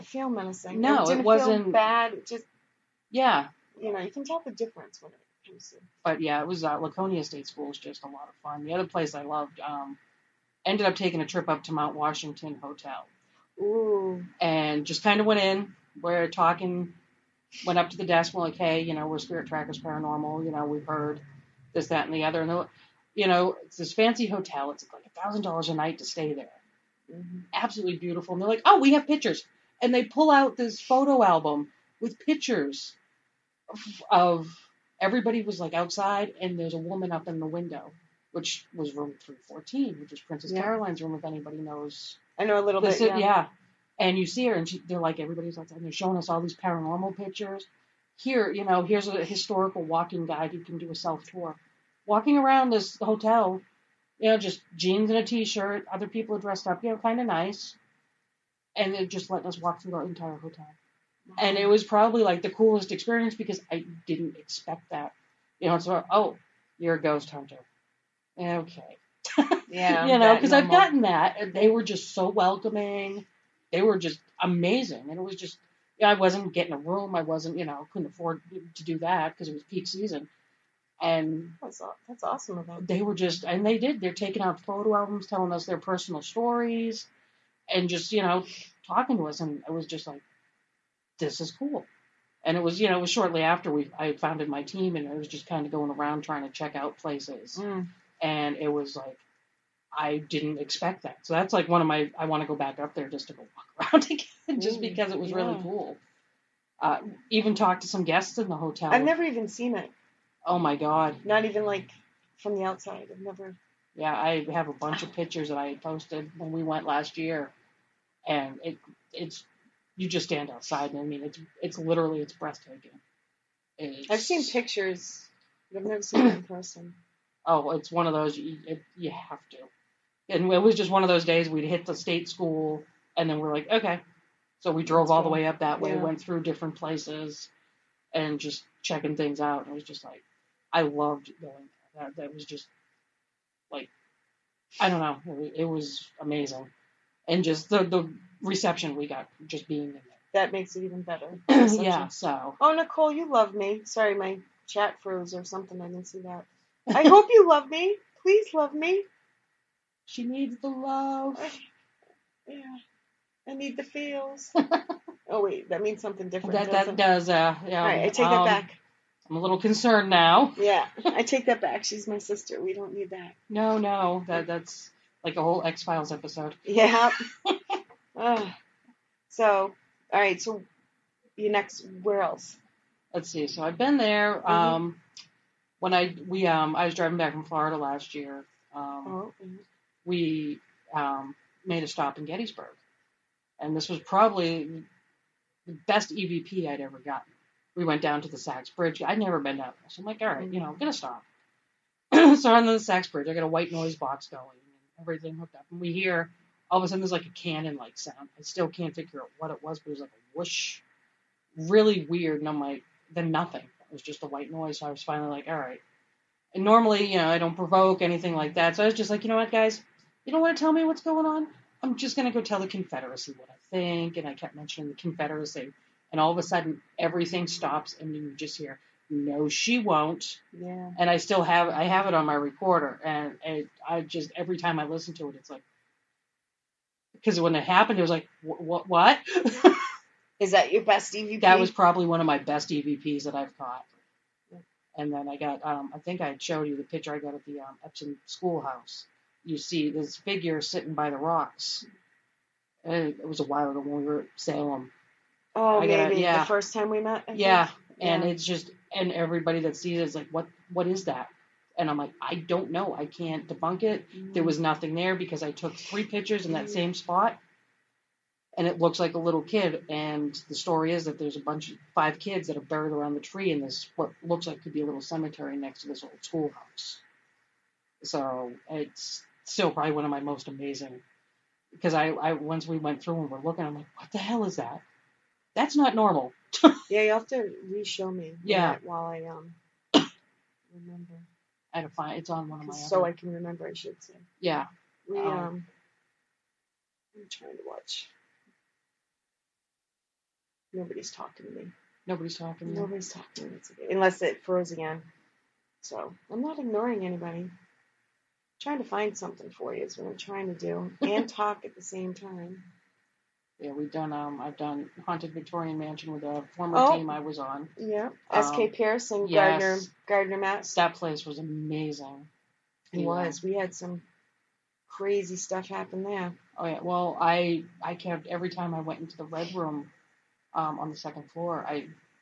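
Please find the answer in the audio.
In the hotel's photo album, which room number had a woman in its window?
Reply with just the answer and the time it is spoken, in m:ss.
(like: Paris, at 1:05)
314, at 0:39.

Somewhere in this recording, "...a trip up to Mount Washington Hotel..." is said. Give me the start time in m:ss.
0:11.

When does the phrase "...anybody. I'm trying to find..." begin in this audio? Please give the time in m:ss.
5:07.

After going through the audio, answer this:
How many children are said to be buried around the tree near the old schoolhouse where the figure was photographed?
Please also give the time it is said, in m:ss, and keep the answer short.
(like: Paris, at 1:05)
5, at 4:31.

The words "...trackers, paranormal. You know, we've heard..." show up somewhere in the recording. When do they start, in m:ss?
0:19.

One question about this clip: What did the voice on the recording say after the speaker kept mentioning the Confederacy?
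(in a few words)
No, she won't.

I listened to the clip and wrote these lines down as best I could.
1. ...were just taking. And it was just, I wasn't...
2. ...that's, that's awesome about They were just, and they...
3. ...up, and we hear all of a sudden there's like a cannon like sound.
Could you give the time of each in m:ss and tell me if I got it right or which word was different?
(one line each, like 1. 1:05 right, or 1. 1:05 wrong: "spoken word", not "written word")
1. 1:13 wrong: "amazing", not "taking"
2. 1:21 right
3. 3:25 right.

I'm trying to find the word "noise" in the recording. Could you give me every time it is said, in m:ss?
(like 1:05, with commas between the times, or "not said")
3:23, 3:34.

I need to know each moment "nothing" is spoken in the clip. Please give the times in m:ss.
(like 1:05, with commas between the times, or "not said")
3:33, 4:24.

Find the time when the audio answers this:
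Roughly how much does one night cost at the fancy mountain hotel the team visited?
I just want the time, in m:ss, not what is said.
0:25.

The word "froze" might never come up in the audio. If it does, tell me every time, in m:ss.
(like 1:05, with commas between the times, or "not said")
2:35, 5:04.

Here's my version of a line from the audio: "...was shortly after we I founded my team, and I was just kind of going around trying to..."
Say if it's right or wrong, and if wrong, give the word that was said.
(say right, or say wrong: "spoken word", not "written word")
right.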